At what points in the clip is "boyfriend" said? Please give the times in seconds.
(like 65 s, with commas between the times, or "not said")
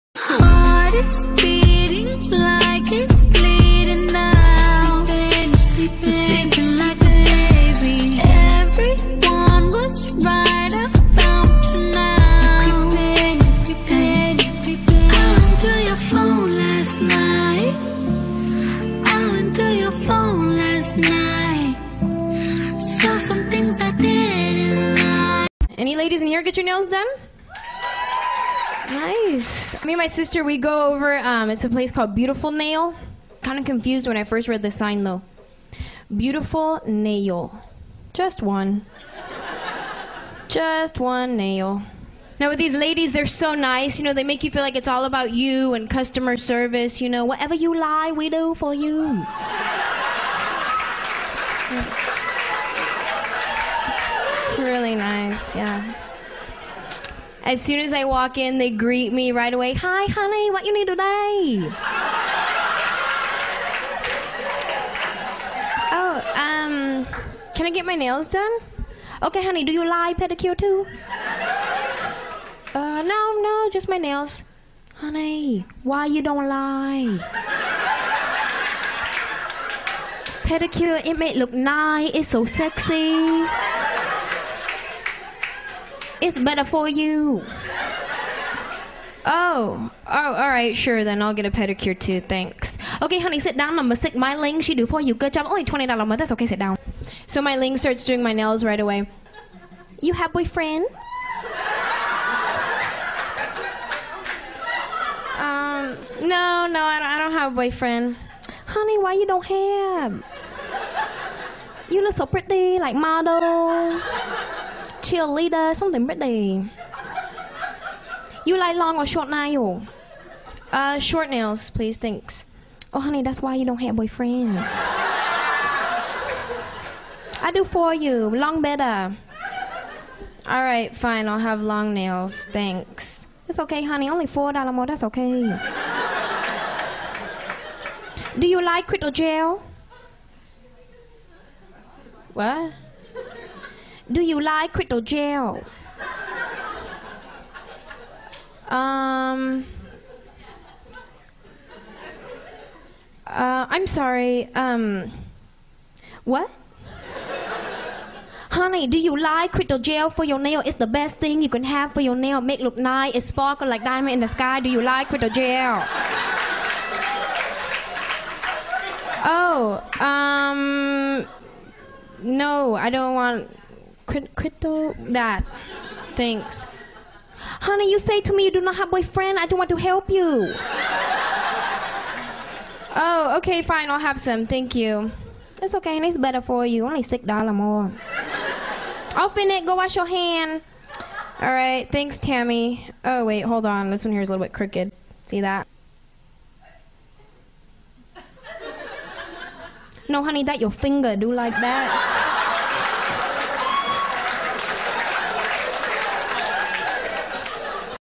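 100 s, 107 s, 123 s, 178 s.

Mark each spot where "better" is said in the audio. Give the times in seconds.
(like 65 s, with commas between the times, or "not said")
86 s, 128 s, 186 s.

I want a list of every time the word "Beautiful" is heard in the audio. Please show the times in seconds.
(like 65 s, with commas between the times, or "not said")
32 s, 36 s.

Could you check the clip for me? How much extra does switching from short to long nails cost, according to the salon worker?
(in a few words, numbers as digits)
$4.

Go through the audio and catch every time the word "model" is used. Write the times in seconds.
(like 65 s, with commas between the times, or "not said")
112 s.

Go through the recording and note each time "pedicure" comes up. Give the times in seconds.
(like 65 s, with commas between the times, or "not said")
70 s, 80 s, 91 s.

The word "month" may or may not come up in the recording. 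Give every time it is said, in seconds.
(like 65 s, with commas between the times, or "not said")
96 s.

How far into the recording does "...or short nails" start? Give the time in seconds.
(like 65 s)
118 s.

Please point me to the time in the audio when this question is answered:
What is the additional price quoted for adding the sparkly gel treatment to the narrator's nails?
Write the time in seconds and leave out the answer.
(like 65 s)
187 s.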